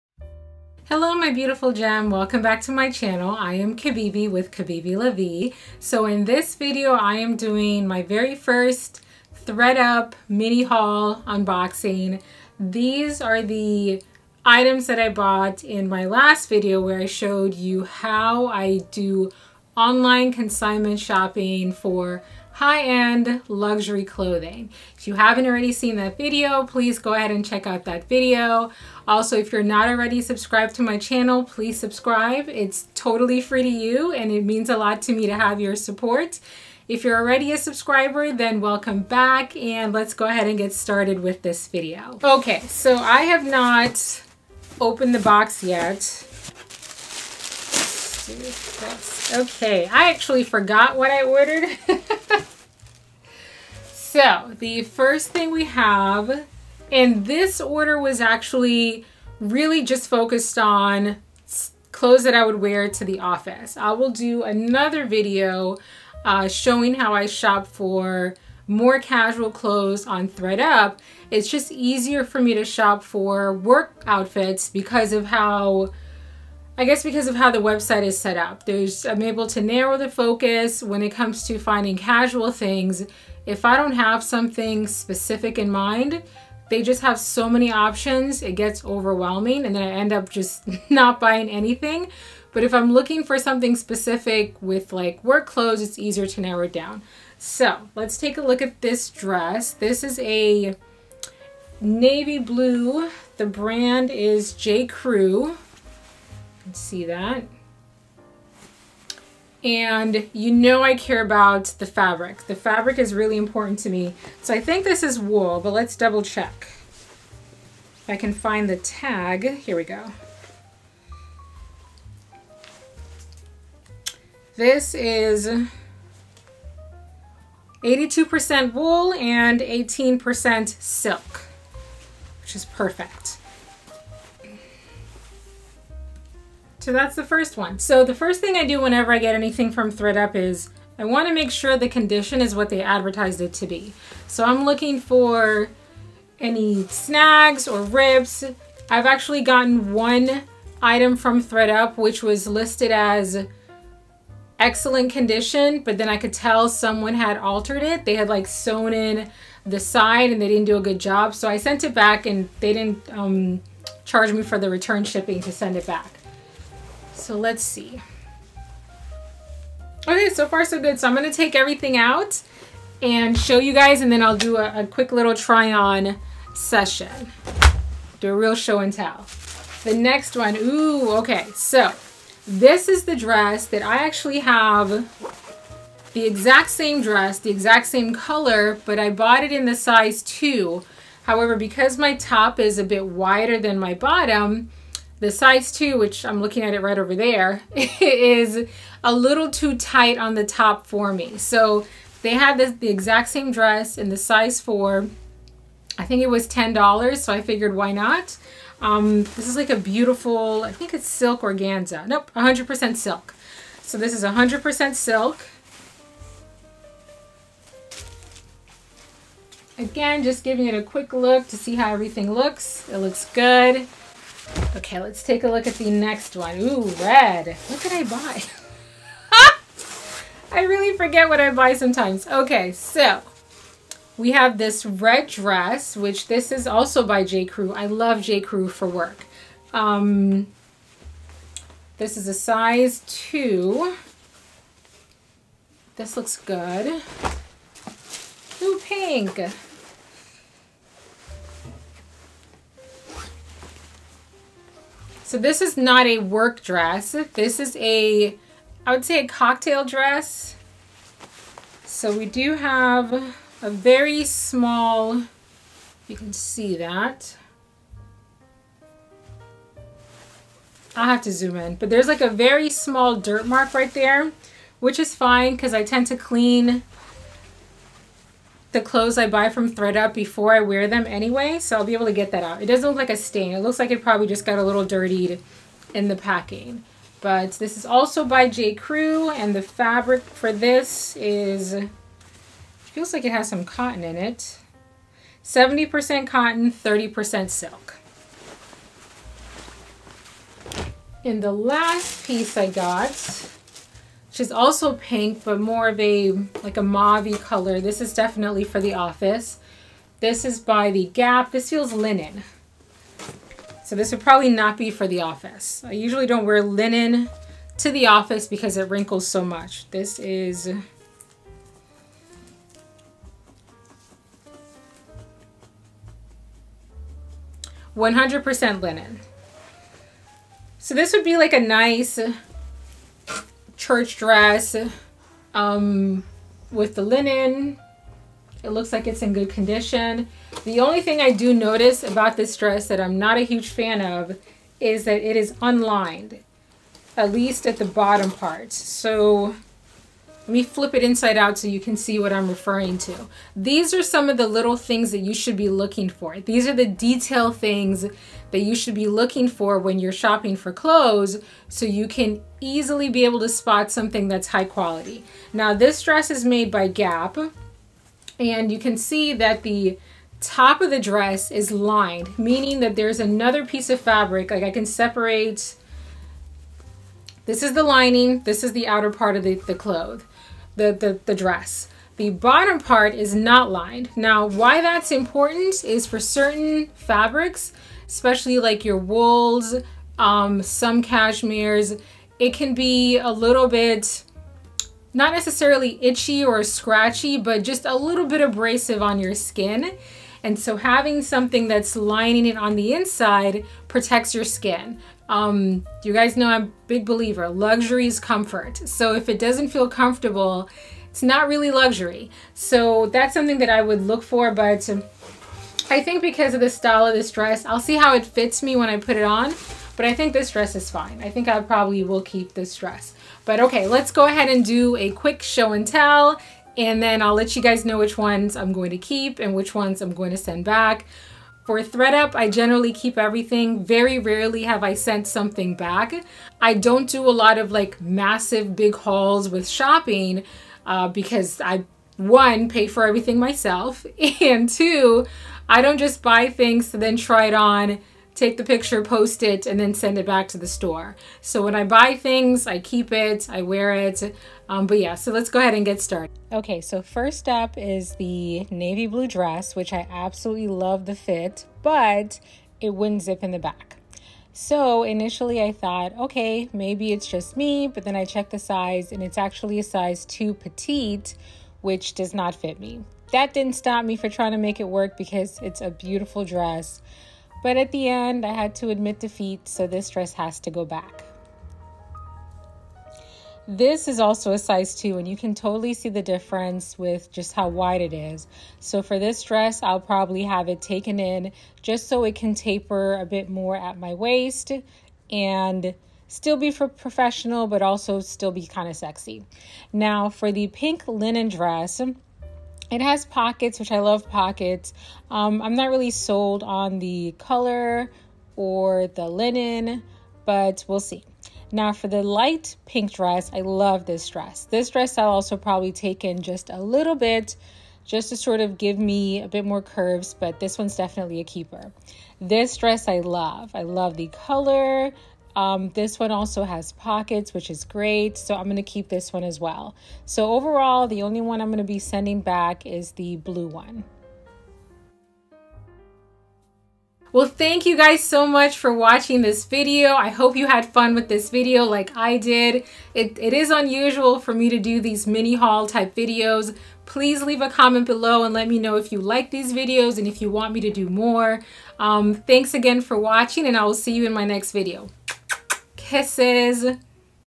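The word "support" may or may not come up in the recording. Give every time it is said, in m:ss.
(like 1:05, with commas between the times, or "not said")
0:35.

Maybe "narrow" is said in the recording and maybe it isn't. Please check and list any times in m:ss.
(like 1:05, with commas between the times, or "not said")
1:19, 1:36.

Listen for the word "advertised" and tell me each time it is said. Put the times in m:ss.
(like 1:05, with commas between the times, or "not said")
2:22.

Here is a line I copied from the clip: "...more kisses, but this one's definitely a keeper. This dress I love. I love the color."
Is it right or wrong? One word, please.
wrong.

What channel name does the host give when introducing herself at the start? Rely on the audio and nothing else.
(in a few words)
Kibibi Vie.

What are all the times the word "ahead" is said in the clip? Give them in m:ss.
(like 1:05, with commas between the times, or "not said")
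0:27, 0:40, 7:04, 7:35.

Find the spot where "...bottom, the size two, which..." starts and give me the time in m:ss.
3:13.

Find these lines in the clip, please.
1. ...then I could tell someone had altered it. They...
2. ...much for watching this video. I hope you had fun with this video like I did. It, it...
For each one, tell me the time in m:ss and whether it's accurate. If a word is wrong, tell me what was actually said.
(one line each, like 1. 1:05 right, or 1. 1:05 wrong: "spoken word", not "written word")
1. 2:35 right
2. 8:58 right.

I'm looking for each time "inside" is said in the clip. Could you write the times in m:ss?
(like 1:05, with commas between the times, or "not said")
5:51, 6:42.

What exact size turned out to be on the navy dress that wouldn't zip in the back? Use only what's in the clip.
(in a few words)
size 2 petite.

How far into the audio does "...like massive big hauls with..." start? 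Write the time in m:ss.
7:17.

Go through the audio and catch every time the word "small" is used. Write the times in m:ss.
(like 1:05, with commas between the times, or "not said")
4:24, 4:32.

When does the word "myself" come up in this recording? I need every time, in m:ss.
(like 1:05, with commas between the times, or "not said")
7:23.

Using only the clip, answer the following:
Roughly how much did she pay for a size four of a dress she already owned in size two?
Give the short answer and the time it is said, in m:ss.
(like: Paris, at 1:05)
$10, at 3:26.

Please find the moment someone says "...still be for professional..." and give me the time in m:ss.
8:16.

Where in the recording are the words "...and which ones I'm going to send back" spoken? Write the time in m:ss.
7:09.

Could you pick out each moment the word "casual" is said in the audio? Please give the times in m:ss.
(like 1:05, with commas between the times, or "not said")
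1:08, 1:21.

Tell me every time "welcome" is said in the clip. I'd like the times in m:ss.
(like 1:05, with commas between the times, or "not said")
0:02, 0:38.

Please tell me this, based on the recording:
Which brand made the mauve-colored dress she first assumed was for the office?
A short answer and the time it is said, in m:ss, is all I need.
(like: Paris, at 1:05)
The Gap, at 5:10.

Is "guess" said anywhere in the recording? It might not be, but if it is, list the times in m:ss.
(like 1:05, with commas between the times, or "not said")
1:16.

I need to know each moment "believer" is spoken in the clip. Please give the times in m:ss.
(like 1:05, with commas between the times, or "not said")
6:47.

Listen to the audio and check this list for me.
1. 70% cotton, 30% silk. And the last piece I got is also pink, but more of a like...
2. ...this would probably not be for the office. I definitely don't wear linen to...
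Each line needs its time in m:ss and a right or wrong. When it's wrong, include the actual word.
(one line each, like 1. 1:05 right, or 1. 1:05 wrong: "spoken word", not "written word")
1. 4:55 right
2. 5:13 wrong: "usually", not "definitely".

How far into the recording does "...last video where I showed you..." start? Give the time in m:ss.
0:16.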